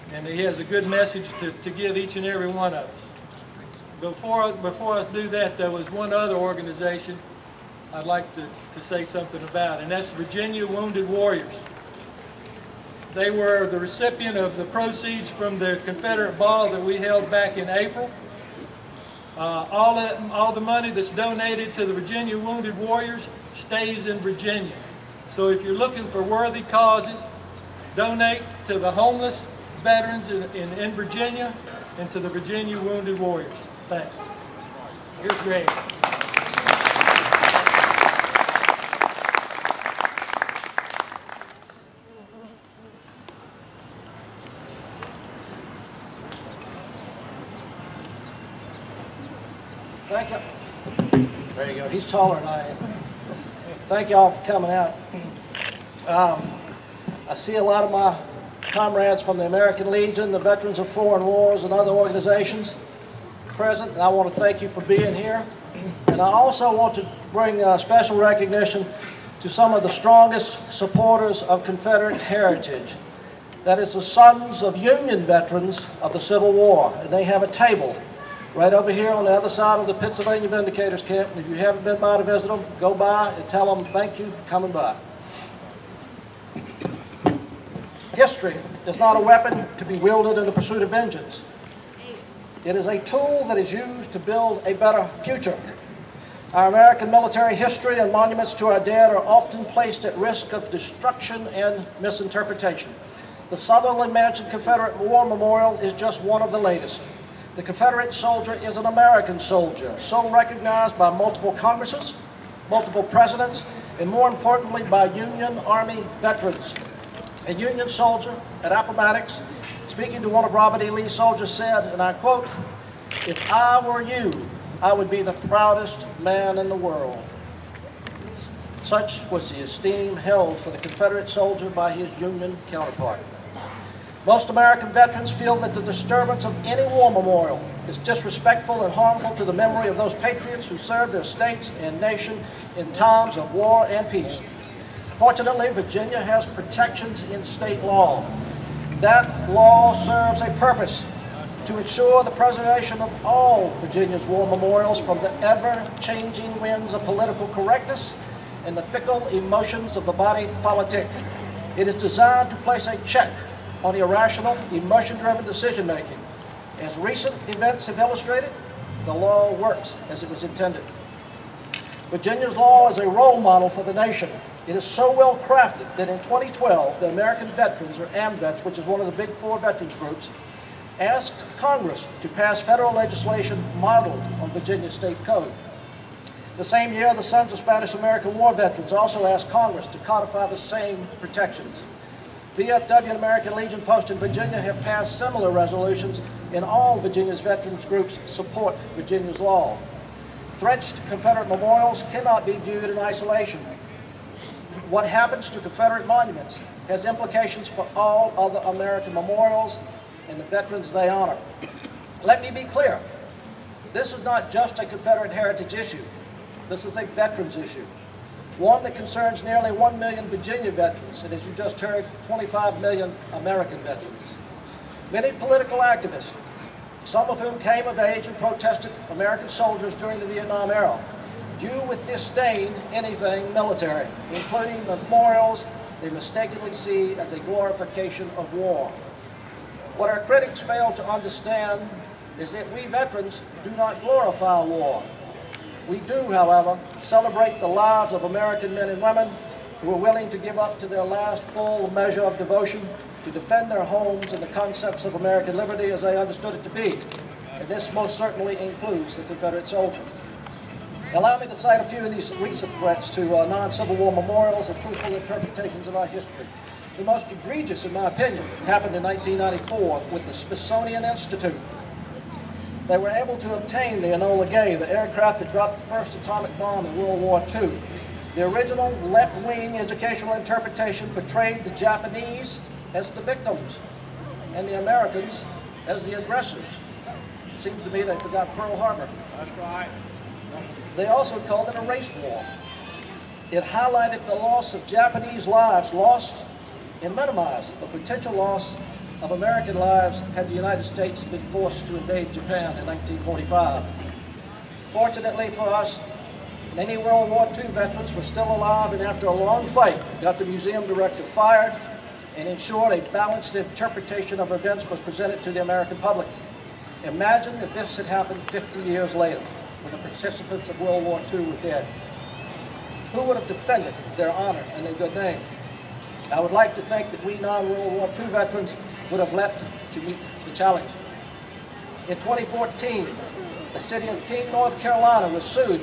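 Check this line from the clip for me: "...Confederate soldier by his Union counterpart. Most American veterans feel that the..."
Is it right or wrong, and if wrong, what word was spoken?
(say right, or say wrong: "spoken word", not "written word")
right.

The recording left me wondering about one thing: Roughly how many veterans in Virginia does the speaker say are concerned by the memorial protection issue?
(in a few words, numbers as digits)
1 million.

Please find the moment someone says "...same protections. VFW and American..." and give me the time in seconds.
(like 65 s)
190 s.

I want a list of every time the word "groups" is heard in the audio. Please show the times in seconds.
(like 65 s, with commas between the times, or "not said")
179 s, 197 s.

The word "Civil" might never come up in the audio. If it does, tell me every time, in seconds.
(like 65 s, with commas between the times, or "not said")
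76 s, 263 s.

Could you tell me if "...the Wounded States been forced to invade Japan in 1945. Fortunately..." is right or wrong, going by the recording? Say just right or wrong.
wrong.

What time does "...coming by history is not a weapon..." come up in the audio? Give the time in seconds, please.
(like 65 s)
84 s.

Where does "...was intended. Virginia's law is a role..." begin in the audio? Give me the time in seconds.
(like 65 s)
170 s.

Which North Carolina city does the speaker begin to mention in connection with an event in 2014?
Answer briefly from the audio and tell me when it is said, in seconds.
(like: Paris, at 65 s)
King, at 334 s.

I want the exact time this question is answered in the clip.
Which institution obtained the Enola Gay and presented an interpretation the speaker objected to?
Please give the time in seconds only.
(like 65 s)
270 s.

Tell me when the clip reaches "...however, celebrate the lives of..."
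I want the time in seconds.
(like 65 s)
246 s.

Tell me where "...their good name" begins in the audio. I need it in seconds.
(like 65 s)
324 s.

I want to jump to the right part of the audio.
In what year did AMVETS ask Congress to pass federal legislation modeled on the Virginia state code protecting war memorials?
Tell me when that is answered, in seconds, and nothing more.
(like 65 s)
176 s.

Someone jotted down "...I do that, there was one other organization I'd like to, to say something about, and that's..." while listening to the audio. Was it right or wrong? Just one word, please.
right.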